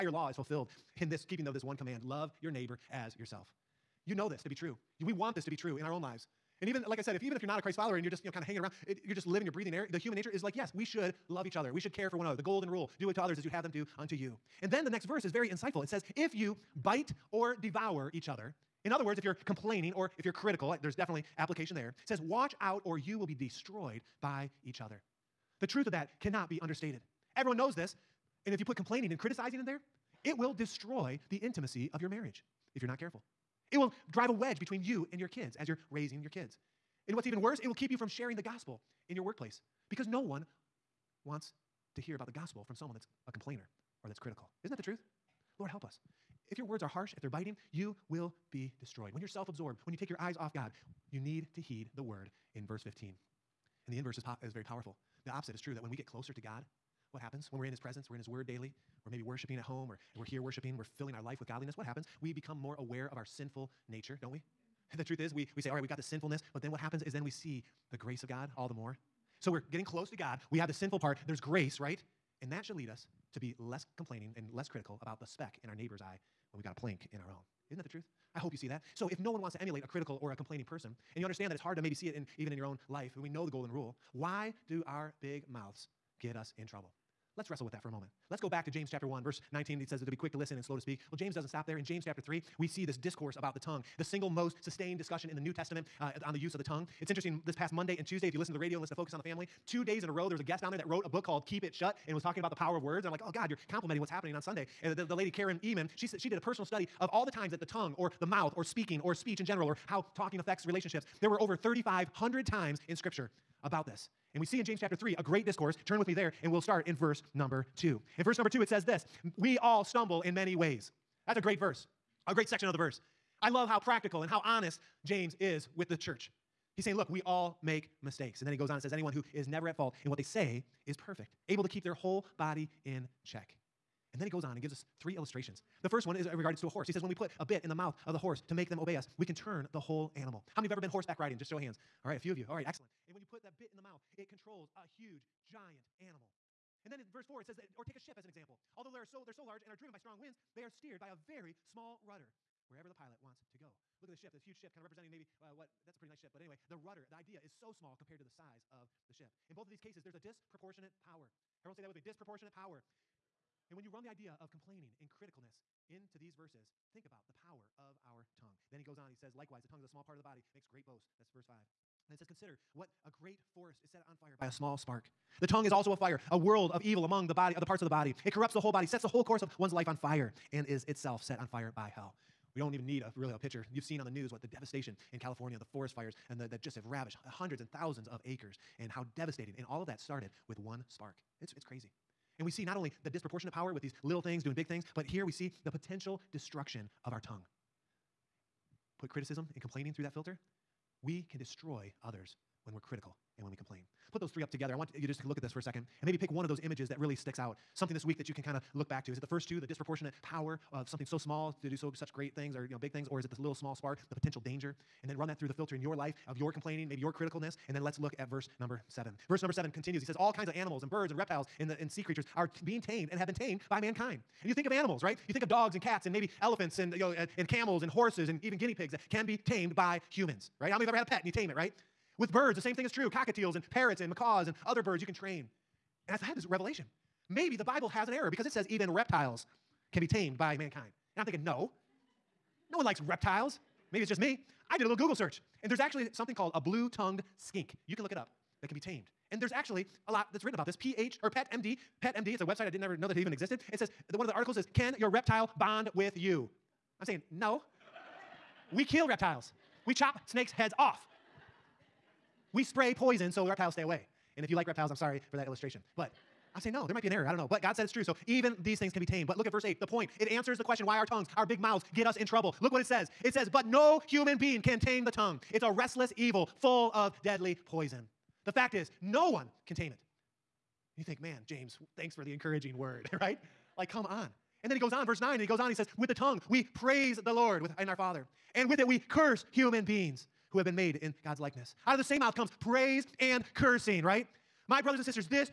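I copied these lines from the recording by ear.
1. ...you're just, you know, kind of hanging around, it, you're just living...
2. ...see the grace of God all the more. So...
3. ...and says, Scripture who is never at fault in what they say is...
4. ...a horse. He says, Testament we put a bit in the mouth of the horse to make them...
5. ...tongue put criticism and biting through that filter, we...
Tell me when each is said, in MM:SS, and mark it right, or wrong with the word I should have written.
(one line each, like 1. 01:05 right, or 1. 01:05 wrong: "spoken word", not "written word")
1. 00:08 right
2. 01:07 right
3. 02:08 wrong: "Anyone", not "Scripture"
4. 02:16 wrong: "When", not "Testament"
5. 03:17 wrong: "complaining", not "biting".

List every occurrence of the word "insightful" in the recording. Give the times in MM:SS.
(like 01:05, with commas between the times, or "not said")
00:15.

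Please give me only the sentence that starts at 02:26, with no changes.
And then in verse 4, it says, that, or take a ship as an example.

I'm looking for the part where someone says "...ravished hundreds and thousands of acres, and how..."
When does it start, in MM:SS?
03:06.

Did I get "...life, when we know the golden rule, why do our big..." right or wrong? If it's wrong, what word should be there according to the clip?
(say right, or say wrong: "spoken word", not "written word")
right.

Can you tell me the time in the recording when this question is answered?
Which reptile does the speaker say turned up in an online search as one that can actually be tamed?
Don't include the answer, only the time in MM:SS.
04:06.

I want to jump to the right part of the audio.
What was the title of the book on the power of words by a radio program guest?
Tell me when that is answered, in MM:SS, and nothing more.
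01:41.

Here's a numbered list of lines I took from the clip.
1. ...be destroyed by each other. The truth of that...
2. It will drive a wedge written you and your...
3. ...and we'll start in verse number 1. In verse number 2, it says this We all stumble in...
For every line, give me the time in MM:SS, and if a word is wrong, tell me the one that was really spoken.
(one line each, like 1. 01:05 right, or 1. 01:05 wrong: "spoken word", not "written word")
1. 00:23 right
2. 00:33 wrong: "between", not "written"
3. 01:56 wrong: "2", not "1".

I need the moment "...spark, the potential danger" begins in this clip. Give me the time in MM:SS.
03:33.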